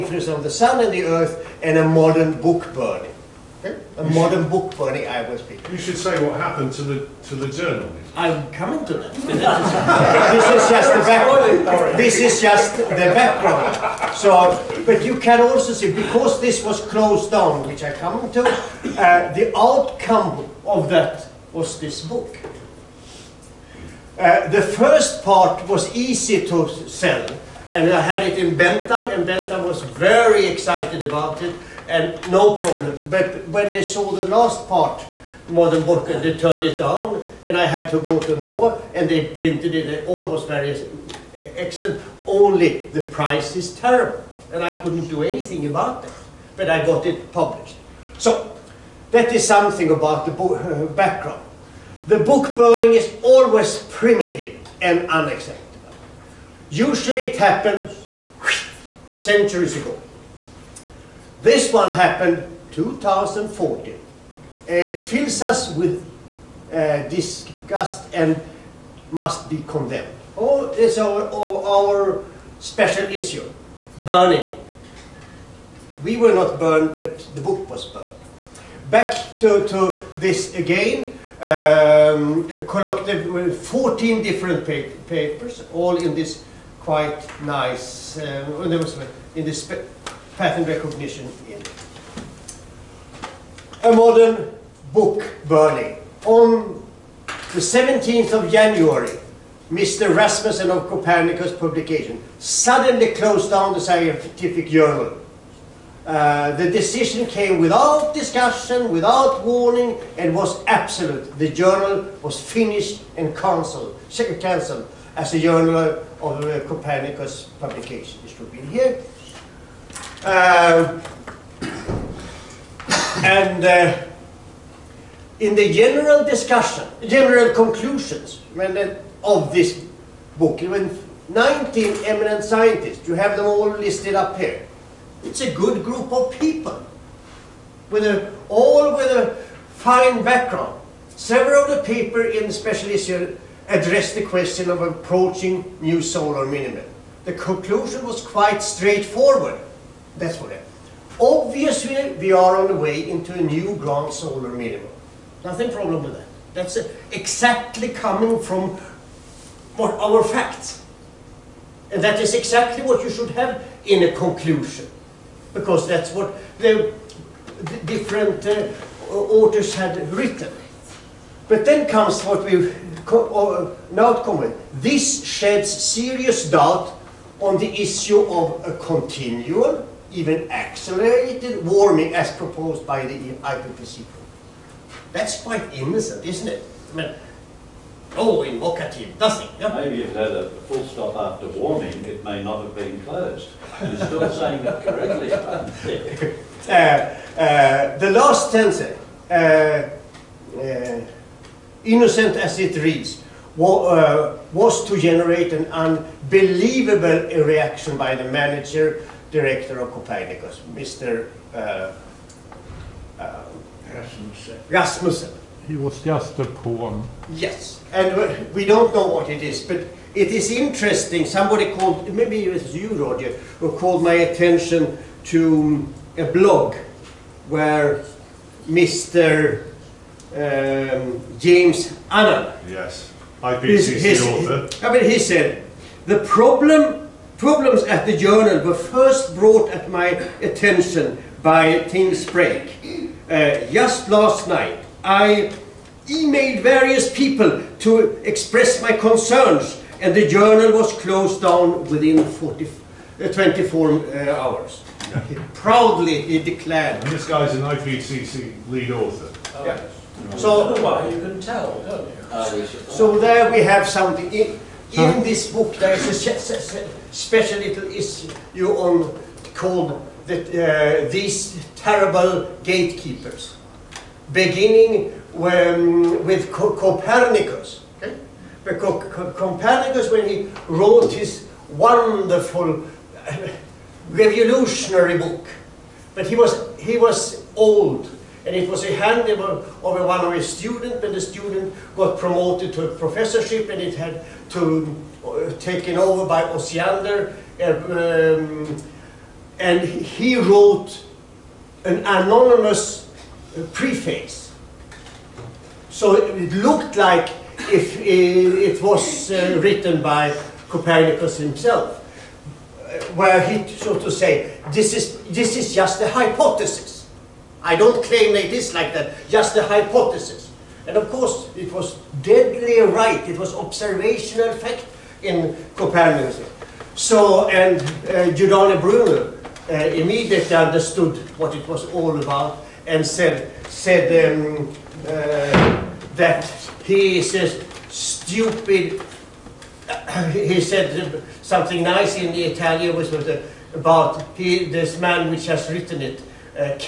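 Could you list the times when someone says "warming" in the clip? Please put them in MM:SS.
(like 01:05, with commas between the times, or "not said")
03:01, 03:11.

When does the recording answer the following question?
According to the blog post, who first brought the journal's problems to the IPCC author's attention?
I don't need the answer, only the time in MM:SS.
04:01.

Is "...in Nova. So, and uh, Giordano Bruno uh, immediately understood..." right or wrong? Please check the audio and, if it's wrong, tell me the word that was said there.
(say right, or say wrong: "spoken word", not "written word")
wrong: "Copernicus", not "Nova".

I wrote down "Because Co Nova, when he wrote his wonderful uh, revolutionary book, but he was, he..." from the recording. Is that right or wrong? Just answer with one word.
wrong.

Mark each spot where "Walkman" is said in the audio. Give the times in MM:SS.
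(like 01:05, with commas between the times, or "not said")
not said.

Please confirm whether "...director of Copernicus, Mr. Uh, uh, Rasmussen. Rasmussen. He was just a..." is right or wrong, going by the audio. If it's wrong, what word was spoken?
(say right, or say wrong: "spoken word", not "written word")
right.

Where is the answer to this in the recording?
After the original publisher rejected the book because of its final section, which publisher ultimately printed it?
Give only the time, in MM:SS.
00:38.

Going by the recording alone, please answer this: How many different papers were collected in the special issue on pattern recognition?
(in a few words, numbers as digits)
14.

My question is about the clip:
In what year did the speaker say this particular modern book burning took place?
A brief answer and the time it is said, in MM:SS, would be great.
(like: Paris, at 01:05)
2014, at 01:02.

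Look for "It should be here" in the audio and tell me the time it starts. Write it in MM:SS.
01:58.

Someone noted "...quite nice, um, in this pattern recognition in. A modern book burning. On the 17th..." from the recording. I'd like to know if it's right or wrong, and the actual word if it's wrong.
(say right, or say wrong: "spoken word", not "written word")
right.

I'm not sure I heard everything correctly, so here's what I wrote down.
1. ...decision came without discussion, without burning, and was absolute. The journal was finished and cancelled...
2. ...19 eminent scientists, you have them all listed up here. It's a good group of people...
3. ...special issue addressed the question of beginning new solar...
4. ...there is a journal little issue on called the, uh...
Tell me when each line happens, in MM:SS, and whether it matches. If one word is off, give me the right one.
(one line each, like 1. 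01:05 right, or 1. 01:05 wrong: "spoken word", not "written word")
1. 01:46 wrong: "warning", not "burning"
2. 02:11 right
3. 02:22 wrong: "approaching", not "beginning"
4. 04:25 wrong: "special", not "journal".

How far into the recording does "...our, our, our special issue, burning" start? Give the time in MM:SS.
01:10.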